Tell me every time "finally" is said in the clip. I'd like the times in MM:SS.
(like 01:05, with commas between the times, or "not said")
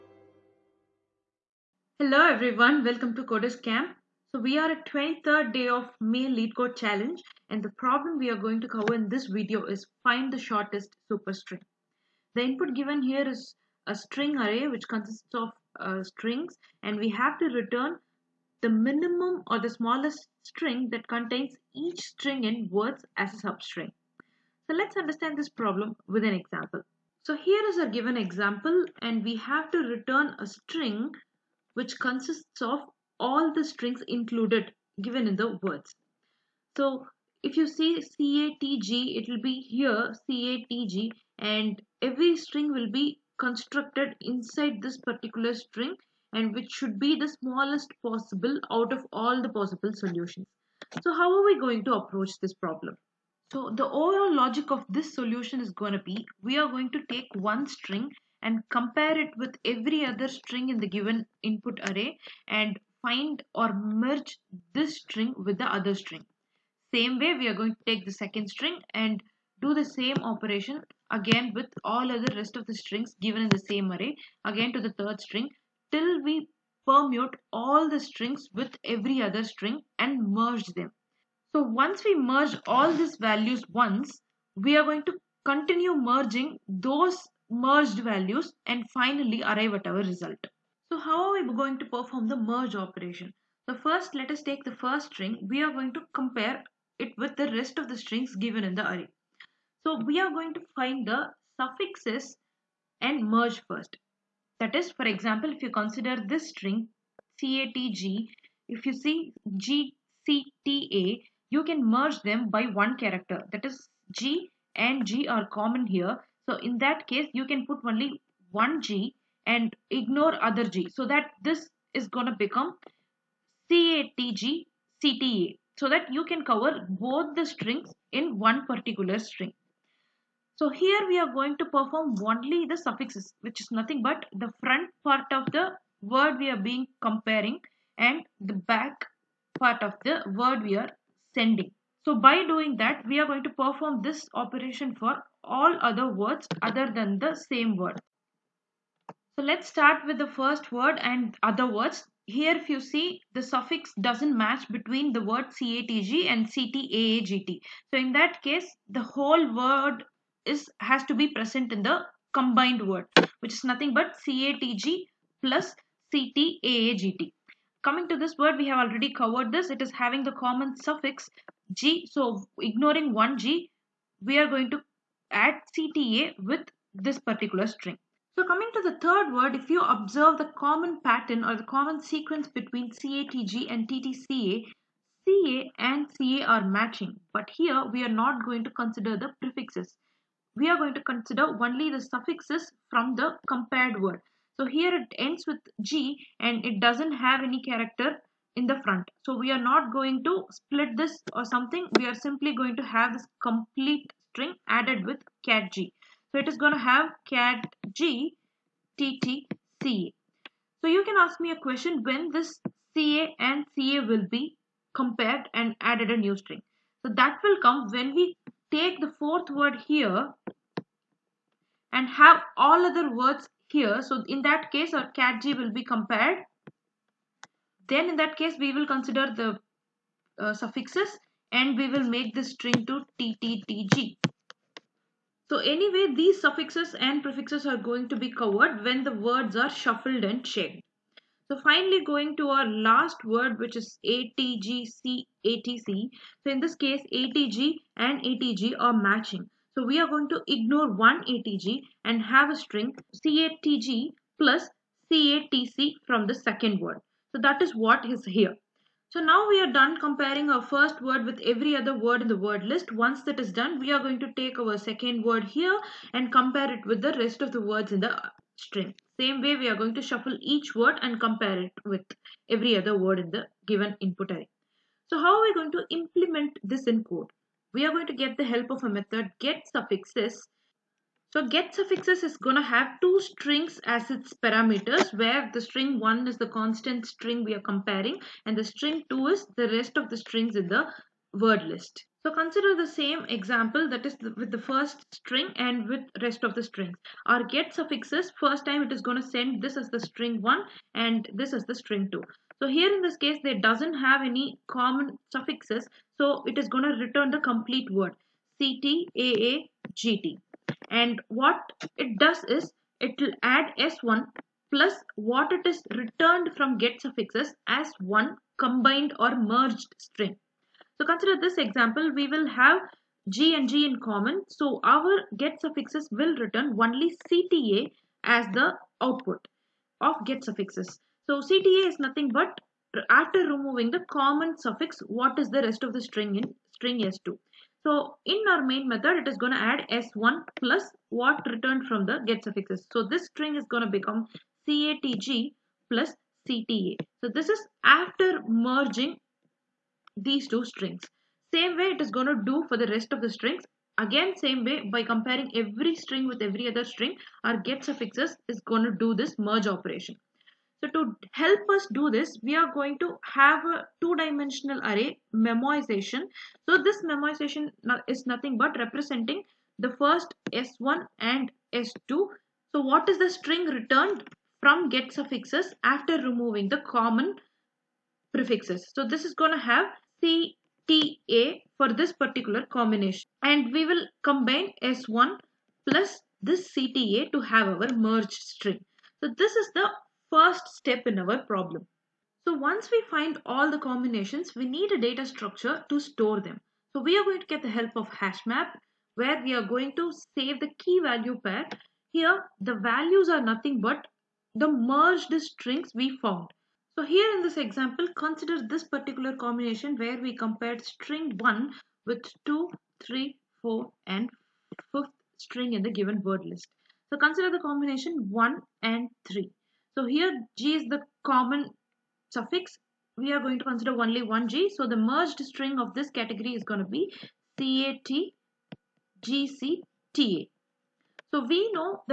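01:28, 04:01.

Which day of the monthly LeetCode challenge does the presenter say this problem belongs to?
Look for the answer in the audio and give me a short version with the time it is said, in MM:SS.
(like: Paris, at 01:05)
23rd, at 00:04.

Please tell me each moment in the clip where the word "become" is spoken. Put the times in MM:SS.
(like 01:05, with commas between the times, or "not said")
02:02, 05:43.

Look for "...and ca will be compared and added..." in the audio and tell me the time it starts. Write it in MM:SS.
03:33.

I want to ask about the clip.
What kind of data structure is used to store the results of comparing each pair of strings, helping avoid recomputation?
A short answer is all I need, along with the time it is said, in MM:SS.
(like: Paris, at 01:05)
two-dimensional array, at 06:04.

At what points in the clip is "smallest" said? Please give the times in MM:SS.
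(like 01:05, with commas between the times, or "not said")
00:19, 00:47.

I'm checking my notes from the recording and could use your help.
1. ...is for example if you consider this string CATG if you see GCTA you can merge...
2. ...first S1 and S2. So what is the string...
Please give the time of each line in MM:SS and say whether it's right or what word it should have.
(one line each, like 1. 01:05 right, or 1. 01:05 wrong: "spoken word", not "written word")
1. 01:44 right
2. 06:09 right.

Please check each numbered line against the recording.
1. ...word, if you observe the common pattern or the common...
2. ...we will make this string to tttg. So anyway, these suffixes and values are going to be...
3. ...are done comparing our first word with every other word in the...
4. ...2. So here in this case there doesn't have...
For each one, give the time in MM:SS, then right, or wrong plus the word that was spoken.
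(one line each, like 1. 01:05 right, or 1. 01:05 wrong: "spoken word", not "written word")
1. 02:59 right
2. 03:51 wrong: "prefixes", not "values"
3. 04:19 right
4. 05:02 right.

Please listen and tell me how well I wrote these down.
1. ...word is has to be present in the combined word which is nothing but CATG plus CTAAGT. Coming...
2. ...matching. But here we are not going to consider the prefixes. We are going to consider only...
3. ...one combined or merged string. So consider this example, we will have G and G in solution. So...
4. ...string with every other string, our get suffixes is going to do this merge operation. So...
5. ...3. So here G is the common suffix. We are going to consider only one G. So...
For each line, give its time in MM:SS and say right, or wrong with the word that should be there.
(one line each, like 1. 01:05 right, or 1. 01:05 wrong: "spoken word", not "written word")
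1. 02:39 right
2. 03:06 right
3. 05:17 wrong: "common", not "solution"
4. 05:55 right
5. 06:59 right.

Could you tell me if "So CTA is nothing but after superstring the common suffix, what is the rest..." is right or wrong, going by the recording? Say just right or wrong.
wrong.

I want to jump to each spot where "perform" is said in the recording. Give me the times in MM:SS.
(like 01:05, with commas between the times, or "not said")
01:31, 02:11, 02:23.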